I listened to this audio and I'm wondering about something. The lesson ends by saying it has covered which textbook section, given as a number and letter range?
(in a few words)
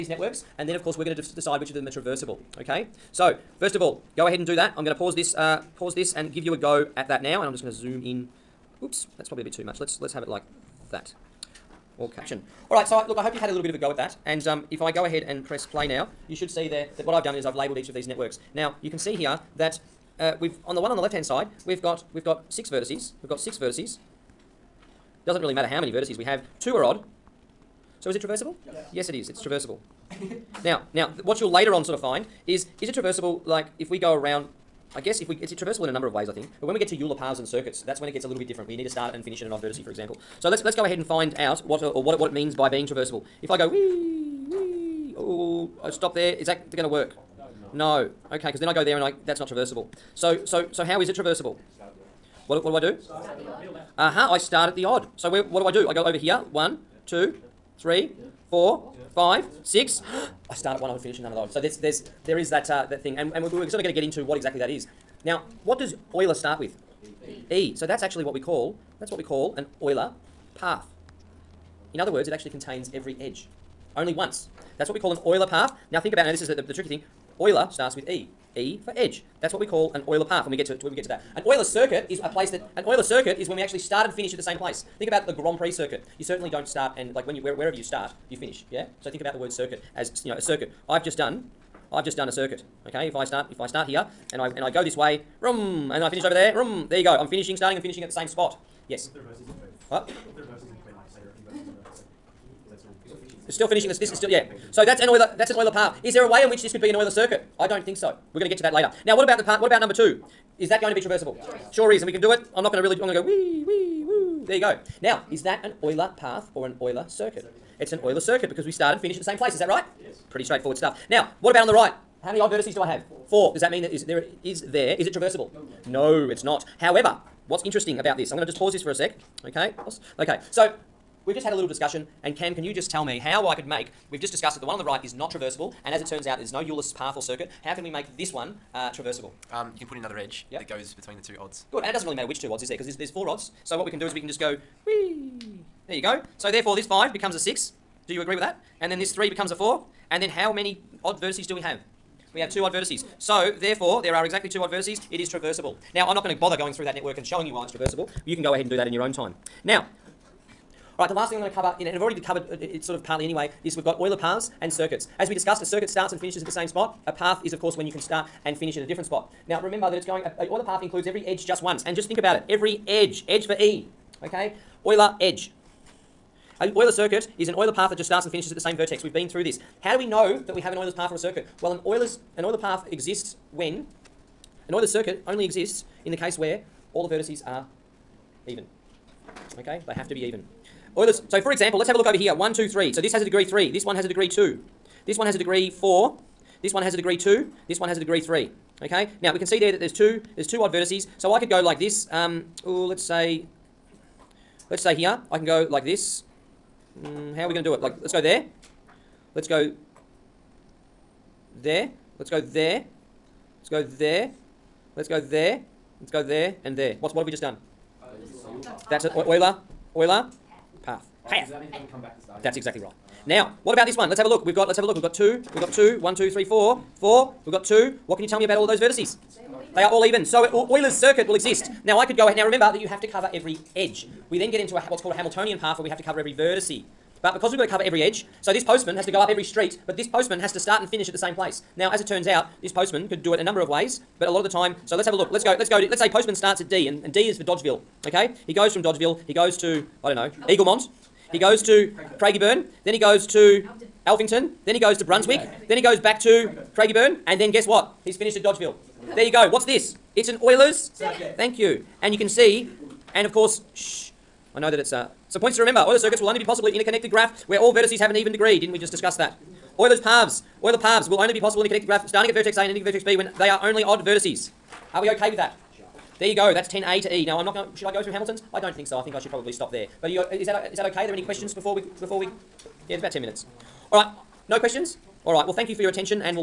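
10A to E.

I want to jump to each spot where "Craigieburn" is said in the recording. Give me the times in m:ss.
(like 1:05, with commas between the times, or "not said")
4:12, 4:16.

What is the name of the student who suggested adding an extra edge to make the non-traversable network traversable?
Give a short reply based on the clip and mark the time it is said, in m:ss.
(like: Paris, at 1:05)
Cam, at 2:12.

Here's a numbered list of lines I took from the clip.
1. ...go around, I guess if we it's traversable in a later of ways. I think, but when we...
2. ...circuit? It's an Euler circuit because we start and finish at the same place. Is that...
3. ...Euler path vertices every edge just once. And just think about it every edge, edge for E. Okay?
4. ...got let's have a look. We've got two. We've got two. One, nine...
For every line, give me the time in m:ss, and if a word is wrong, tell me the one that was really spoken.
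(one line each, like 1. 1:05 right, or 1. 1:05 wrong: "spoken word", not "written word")
1. 0:33 wrong: "number", not "later"
2. 1:57 right
3. 2:50 wrong: "includes", not "vertices"
4. 3:44 wrong: "two", not "nine".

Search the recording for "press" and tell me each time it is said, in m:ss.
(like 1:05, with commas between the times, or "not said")
0:15.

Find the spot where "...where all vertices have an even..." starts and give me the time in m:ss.
4:27.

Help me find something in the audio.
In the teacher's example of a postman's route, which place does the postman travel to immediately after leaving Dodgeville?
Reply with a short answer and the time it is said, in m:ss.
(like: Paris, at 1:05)
Eaglemont, at 4:10.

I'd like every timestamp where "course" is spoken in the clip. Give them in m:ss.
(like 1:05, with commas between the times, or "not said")
0:00, 2:47, 4:23.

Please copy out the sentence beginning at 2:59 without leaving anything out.
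How do we know that we have an Euler's path or a circuit?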